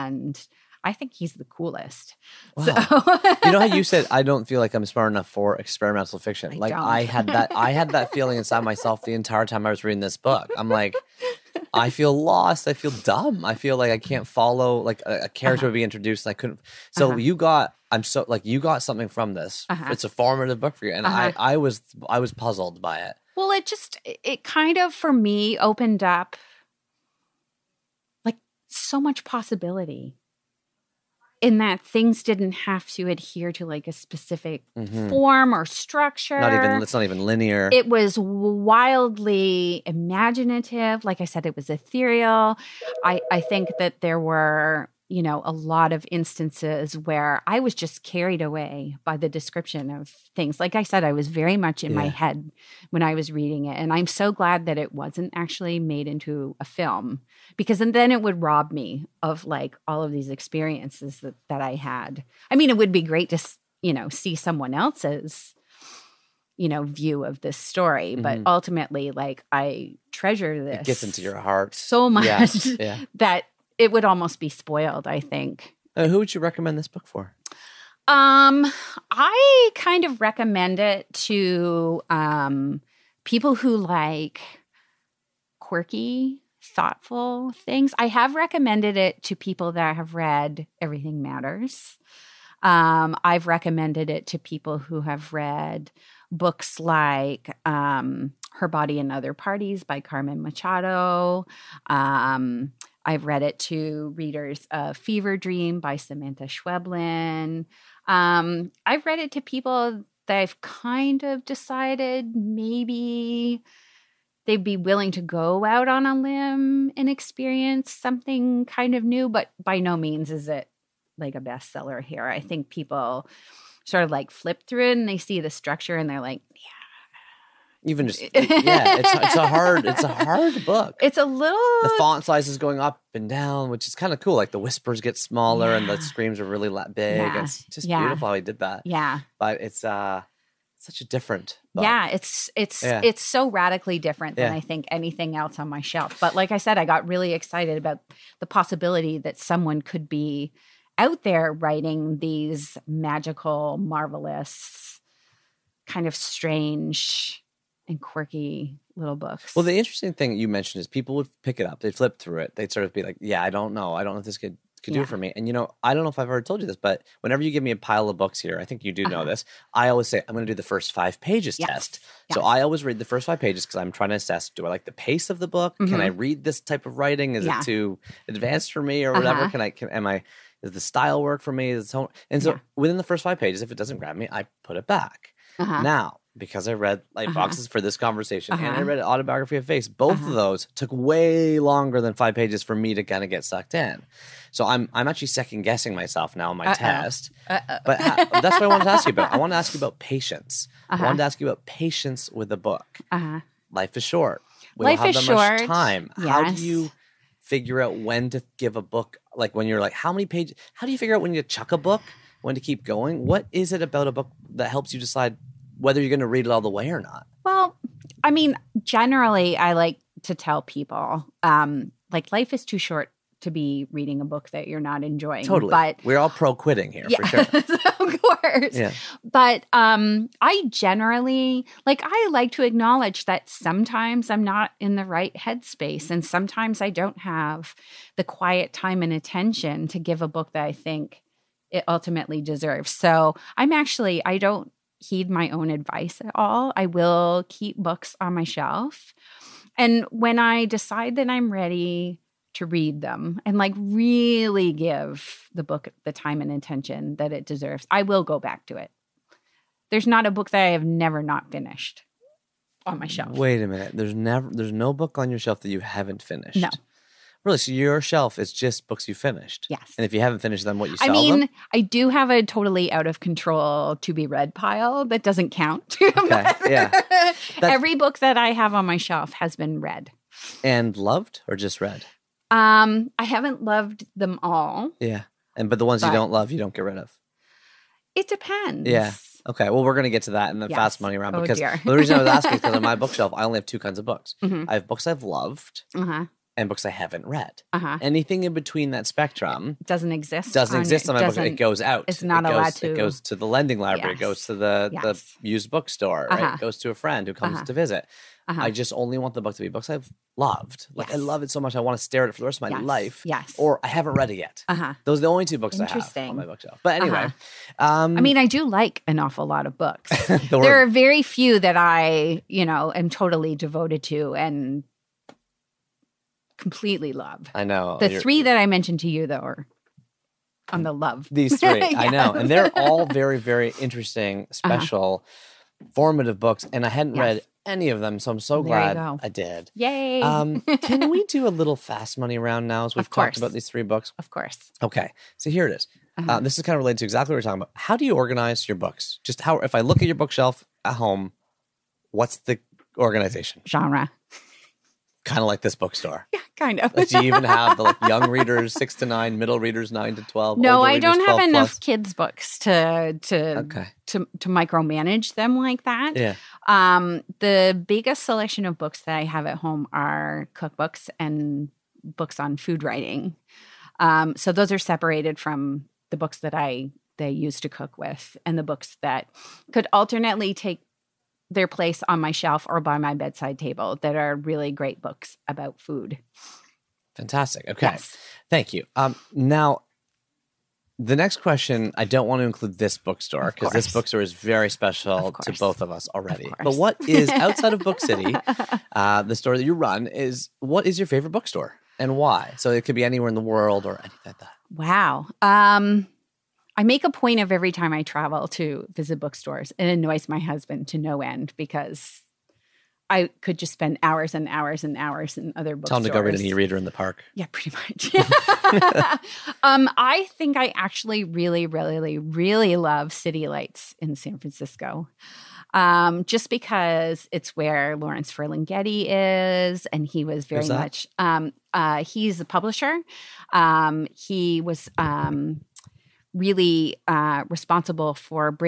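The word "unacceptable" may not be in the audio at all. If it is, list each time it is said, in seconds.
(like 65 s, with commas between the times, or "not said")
not said.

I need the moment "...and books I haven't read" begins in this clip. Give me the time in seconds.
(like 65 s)
296 s.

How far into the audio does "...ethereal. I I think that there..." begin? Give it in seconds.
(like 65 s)
41 s.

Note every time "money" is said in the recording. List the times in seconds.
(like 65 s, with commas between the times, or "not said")
290 s, 342 s.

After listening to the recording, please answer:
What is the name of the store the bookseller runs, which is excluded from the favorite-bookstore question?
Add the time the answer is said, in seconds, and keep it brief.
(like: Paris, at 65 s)
Book City, at 397 s.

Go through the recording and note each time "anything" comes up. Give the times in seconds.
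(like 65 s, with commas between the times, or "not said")
144 s, 297 s, 403 s.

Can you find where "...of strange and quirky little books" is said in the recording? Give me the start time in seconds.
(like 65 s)
156 s.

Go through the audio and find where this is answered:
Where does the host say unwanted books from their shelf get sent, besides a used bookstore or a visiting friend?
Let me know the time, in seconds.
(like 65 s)
303 s.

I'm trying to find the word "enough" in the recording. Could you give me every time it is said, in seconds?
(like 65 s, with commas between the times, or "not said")
5 s, 361 s.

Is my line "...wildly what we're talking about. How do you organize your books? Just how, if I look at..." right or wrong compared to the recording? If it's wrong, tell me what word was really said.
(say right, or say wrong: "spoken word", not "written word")
wrong: "exactly", not "wildly".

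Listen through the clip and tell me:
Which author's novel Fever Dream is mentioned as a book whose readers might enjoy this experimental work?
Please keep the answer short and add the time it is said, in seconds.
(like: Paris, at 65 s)
Samantha Schweblin, at 105 s.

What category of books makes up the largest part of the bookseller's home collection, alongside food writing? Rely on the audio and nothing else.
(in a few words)
cookbooks.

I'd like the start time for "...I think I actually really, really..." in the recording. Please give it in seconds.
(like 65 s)
419 s.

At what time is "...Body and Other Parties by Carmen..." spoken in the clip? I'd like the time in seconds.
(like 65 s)
98 s.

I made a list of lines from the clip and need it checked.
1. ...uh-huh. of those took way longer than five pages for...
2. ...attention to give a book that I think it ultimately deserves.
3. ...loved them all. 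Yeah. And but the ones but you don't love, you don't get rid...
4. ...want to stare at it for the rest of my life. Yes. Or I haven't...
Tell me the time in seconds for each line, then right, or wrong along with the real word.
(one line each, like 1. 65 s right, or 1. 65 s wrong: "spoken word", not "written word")
1. 190 s right
2. 239 s right
3. 283 s right
4. 311 s right.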